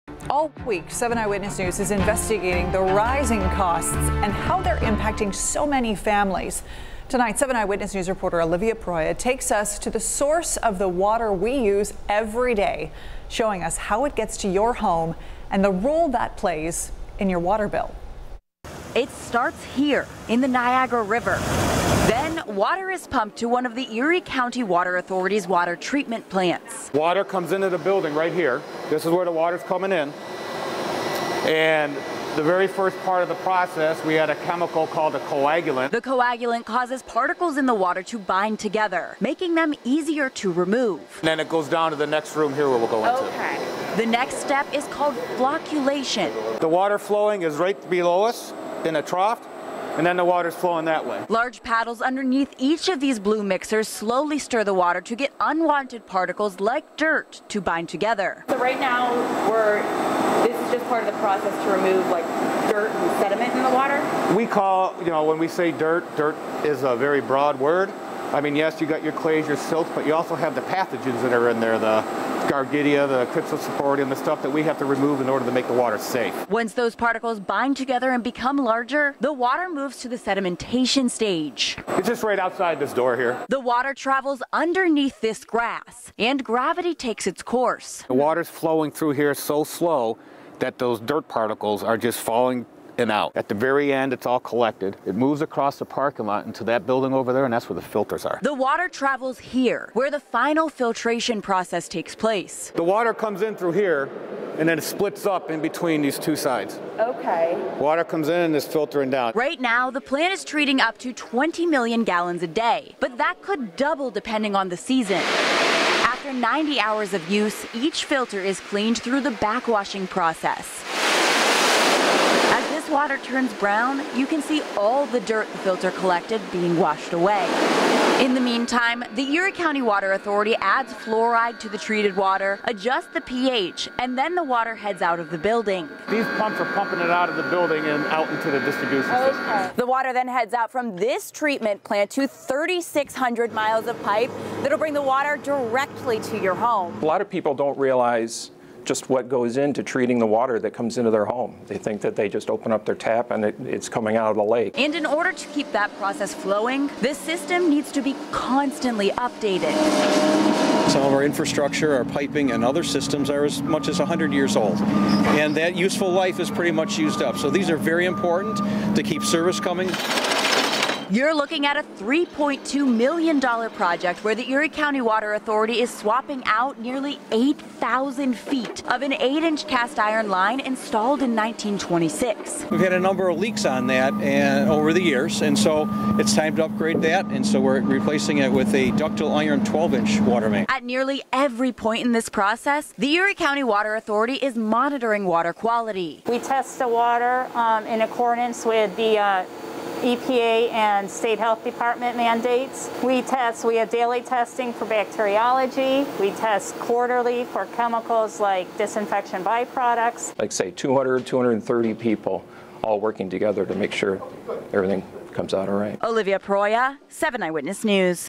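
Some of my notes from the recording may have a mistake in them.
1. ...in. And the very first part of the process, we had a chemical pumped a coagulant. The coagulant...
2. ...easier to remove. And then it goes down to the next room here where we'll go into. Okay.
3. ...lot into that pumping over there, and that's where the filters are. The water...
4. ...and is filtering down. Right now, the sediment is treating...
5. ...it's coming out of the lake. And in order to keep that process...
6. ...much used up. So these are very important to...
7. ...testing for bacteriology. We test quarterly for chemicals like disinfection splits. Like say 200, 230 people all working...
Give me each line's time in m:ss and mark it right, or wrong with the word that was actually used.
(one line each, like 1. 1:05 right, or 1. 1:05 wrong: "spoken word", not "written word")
1. 0:29 wrong: "called", not "pumped"
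2. 0:39 right
3. 1:36 wrong: "building", not "pumping"
4. 1:48 wrong: "plant", not "sediment"
5. 2:33 right
6. 2:46 right
7. 3:24 wrong: "byproducts", not "splits".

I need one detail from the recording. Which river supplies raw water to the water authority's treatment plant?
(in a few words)
Niagara River.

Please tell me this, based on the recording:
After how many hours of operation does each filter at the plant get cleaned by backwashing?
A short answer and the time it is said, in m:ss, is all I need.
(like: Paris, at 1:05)
90 hours, at 1:56.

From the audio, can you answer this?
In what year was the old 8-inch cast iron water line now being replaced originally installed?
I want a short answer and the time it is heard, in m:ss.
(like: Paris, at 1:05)
1926, at 3:01.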